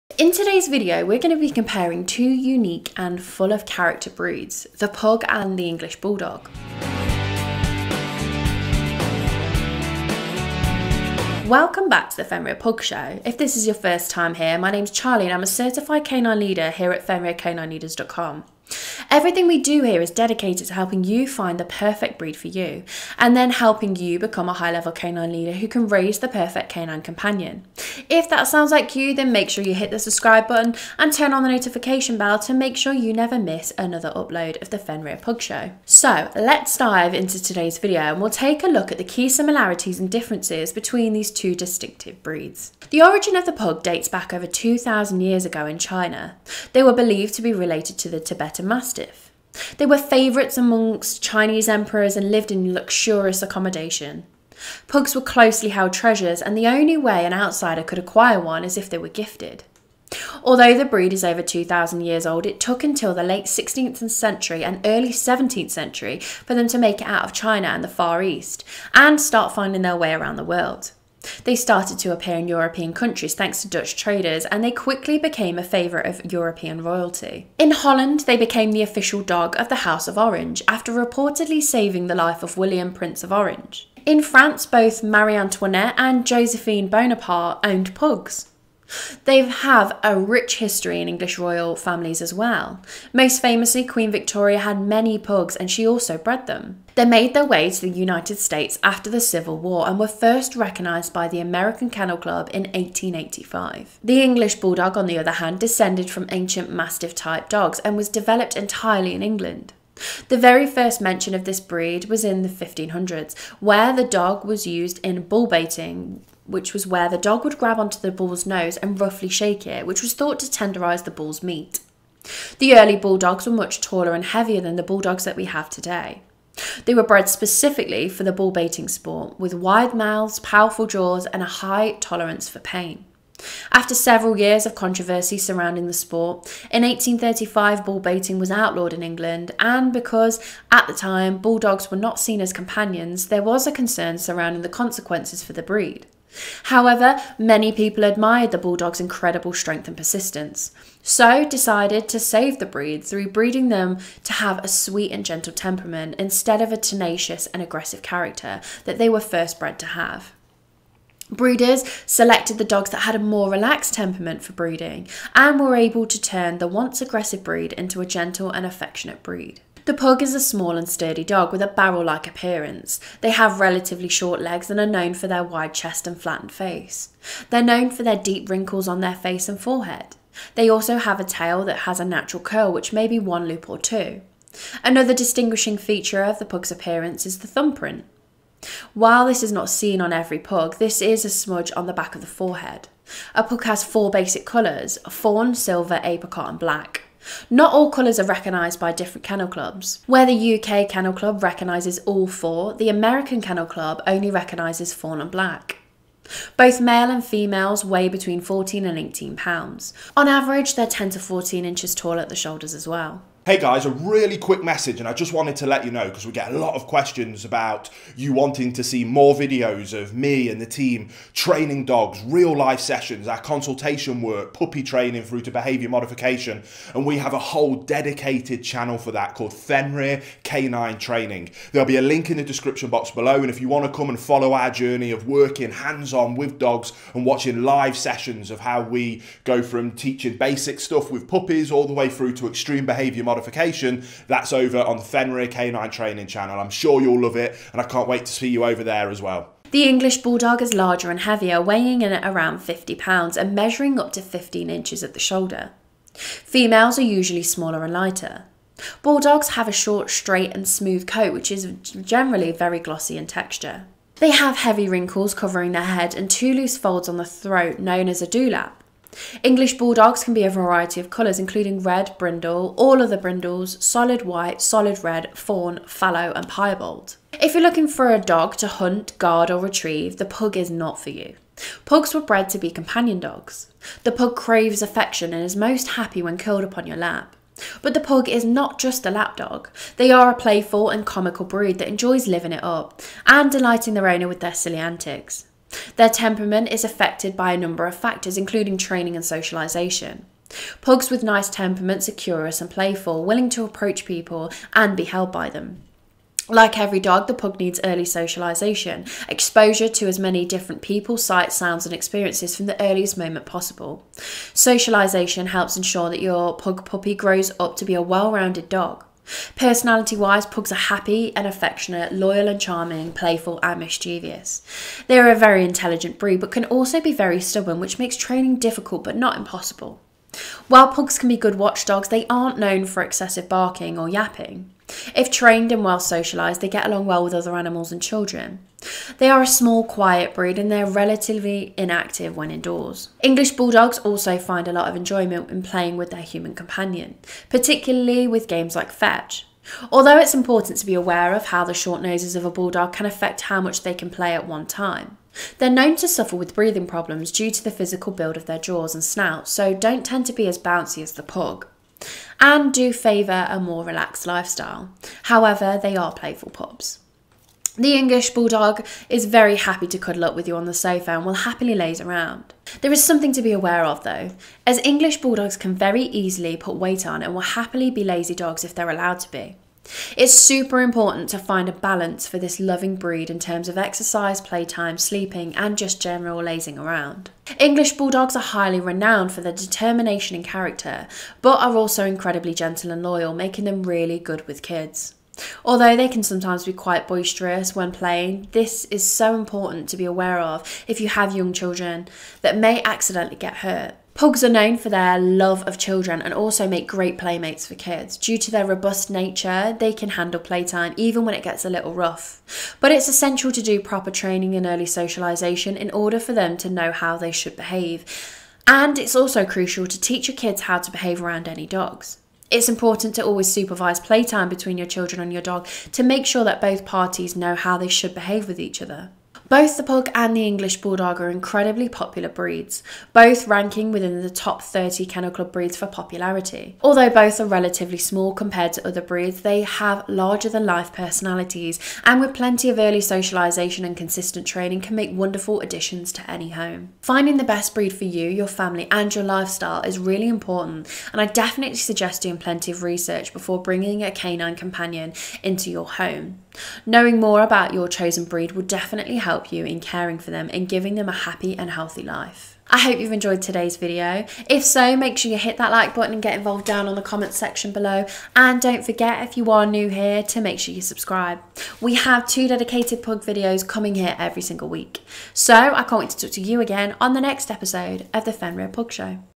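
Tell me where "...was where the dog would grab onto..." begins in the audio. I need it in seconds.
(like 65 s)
116 s.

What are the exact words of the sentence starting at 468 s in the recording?
And don't forget, if you are new here, to make sure you subscribe.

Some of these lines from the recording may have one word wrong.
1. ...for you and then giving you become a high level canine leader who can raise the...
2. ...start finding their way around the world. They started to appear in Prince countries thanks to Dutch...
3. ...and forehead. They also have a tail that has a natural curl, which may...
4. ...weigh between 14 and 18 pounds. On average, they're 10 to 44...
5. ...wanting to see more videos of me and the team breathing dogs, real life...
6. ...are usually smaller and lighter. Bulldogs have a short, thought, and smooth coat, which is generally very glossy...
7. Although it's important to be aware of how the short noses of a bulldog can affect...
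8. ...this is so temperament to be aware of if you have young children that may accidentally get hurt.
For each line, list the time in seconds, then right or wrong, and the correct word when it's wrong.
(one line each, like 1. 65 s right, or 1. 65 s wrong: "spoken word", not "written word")
1. 22 s wrong: "helping", not "giving"
2. 69 s wrong: "European", not "Prince"
3. 179 s right
4. 207 s wrong: "14", not "44"
5. 218 s wrong: "training", not "breathing"
6. 256 s wrong: "straight", not "thought"
7. 349 s right
8. 398 s wrong: "important", not "temperament".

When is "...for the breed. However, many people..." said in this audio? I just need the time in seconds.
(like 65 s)
145 s.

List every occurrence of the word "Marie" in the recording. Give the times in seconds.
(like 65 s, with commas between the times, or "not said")
85 s.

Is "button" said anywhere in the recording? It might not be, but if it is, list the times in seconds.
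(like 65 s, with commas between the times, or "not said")
30 s, 465 s.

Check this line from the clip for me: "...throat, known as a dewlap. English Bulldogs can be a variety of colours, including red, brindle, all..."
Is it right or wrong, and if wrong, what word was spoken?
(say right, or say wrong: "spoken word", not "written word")
right.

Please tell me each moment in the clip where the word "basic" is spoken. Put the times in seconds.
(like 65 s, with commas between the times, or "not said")
194 s, 240 s.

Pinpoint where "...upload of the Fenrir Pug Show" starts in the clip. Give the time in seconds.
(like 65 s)
34 s.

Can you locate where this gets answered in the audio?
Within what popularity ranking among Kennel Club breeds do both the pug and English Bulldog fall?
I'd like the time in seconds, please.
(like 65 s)
434 s.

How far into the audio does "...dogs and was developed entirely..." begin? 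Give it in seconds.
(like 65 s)
107 s.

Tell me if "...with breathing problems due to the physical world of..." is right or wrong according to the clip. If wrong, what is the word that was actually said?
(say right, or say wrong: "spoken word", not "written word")
wrong: "build", not "world".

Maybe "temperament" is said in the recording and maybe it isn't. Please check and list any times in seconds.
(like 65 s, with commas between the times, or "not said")
155 s, 163 s, 296 s, 301 s.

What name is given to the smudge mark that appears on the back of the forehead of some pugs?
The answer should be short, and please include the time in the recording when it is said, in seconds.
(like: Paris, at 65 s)
thumbprint, at 187 s.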